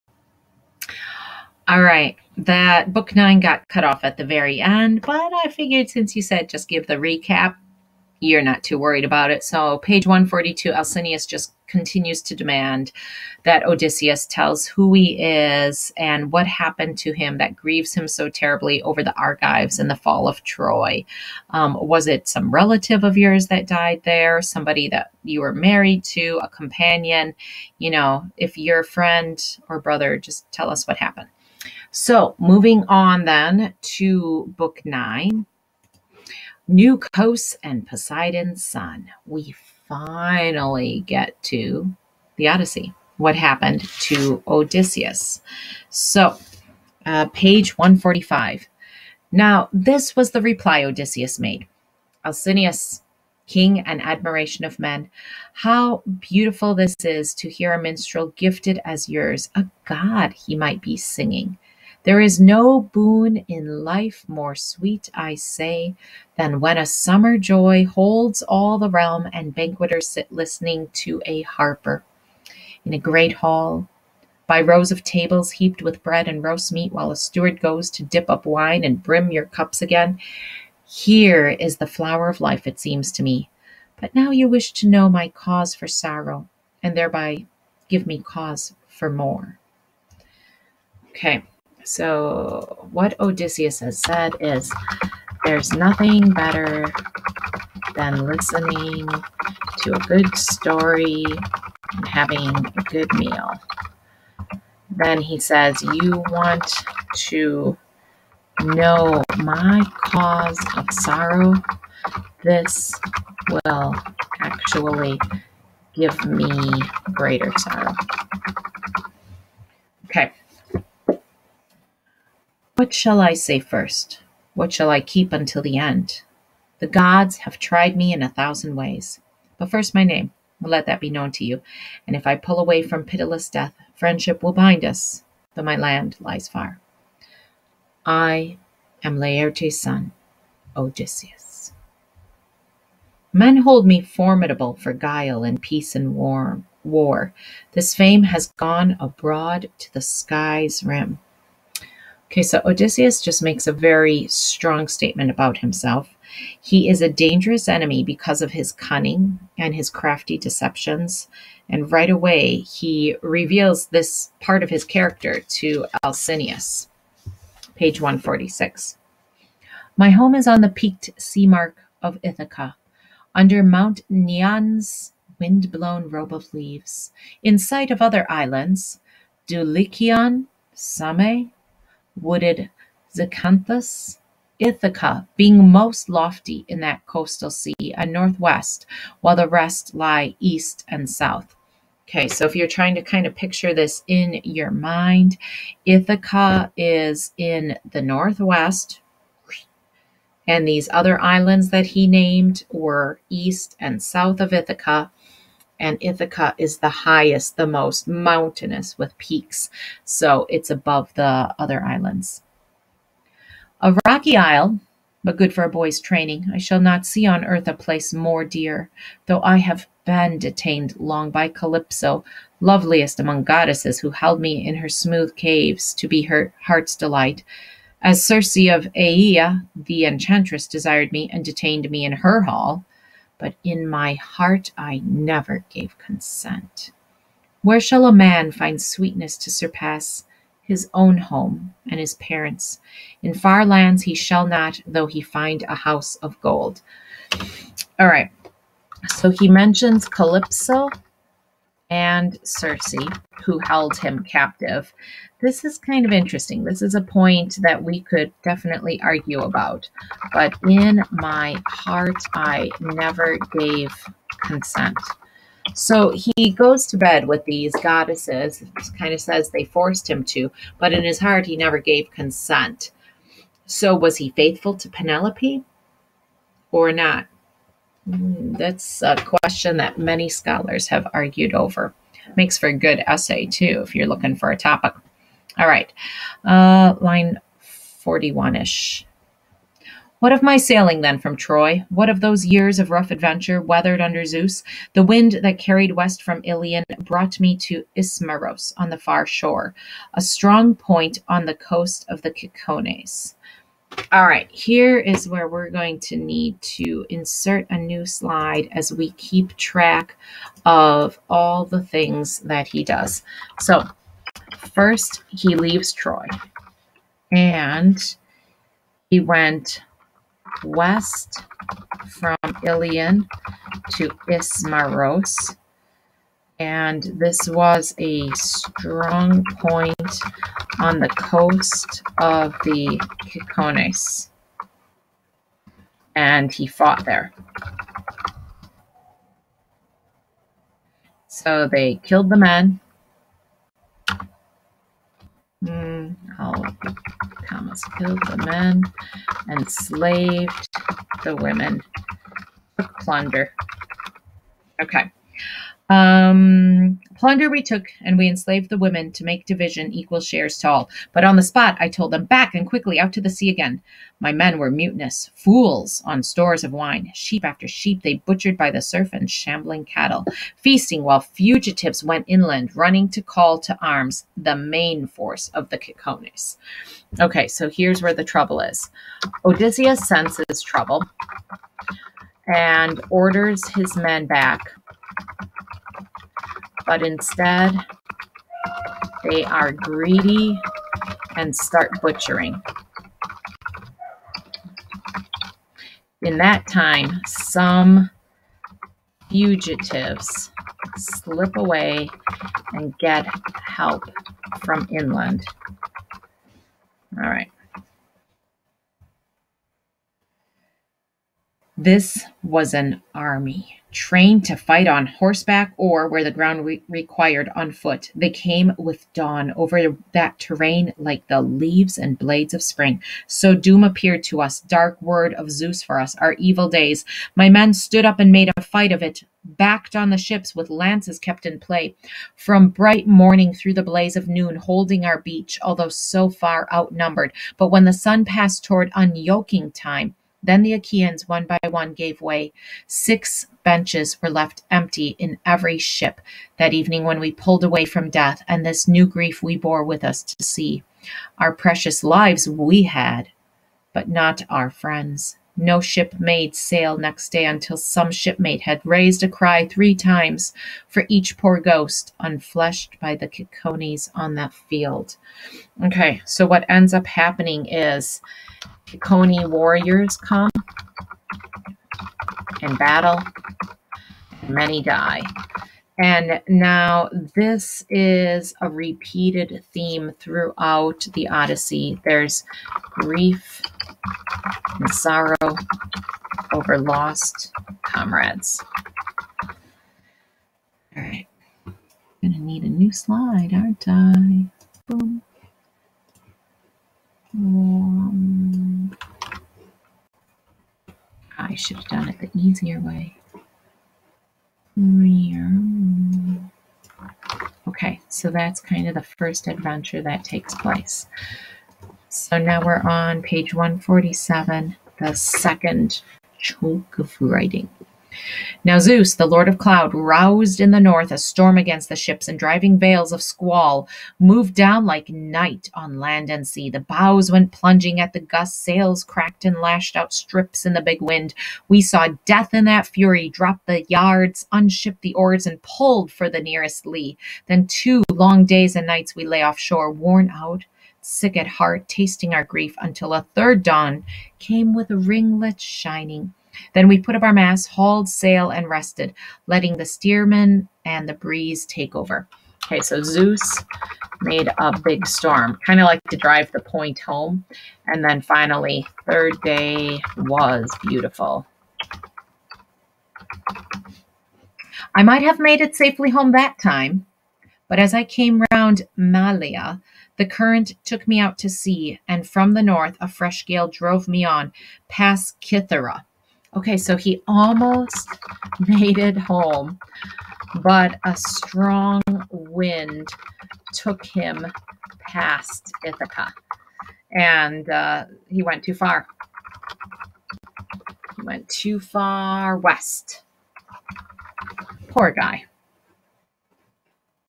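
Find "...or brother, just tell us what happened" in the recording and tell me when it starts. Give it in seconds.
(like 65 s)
29 s.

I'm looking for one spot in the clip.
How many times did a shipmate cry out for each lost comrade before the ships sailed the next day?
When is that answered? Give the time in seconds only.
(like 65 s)
459 s.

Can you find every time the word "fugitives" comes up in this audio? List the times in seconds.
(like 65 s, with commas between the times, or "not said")
371 s, 399 s.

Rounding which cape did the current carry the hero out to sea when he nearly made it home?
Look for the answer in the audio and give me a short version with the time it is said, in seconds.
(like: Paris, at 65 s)
Malia, at 568 s.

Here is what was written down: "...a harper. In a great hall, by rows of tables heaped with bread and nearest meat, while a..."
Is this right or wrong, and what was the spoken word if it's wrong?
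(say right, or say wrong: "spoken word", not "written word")
wrong: "roast", not "nearest".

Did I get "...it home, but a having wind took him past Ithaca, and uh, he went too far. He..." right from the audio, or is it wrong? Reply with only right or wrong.
wrong.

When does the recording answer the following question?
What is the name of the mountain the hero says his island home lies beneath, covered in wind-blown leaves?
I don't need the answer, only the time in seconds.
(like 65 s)
173 s.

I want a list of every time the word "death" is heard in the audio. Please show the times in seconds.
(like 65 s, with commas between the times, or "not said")
133 s, 448 s, 532 s.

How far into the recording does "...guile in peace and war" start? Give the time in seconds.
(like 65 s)
144 s.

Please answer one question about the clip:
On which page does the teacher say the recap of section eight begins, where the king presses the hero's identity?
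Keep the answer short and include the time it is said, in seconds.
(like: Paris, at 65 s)
142, at 10 s.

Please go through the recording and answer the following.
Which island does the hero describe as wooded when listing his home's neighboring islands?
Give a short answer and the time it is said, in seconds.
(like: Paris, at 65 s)
Zakynthos, at 183 s.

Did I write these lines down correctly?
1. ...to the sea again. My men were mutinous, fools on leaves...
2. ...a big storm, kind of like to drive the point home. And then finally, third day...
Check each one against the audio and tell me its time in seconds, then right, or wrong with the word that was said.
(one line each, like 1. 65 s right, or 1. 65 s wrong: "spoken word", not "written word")
1. 363 s wrong: "stores", not "leaves"
2. 554 s right.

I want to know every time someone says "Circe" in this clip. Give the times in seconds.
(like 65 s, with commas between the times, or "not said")
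228 s, 252 s.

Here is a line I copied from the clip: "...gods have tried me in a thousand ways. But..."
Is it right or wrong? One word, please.
right.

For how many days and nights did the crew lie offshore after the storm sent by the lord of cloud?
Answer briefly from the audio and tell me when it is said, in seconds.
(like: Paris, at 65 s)
2, at 537 s.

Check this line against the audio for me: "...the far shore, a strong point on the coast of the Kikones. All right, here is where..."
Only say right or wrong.
right.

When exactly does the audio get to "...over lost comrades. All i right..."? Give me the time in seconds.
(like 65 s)
486 s.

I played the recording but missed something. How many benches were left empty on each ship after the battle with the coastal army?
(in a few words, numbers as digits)
6.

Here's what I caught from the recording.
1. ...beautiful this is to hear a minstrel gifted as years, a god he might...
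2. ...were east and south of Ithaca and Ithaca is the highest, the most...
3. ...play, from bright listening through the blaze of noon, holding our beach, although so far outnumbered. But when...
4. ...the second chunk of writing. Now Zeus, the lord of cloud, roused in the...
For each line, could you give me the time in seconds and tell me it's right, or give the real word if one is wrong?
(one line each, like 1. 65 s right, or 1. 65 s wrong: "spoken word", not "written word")
1. 56 s wrong: "yours", not "years"
2. 202 s right
3. 431 s wrong: "morning", not "listening"
4. 514 s right.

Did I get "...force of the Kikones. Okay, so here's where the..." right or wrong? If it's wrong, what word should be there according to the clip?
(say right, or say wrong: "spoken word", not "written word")
right.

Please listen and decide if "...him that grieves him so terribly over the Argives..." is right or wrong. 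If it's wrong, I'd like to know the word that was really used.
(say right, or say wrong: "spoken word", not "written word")
right.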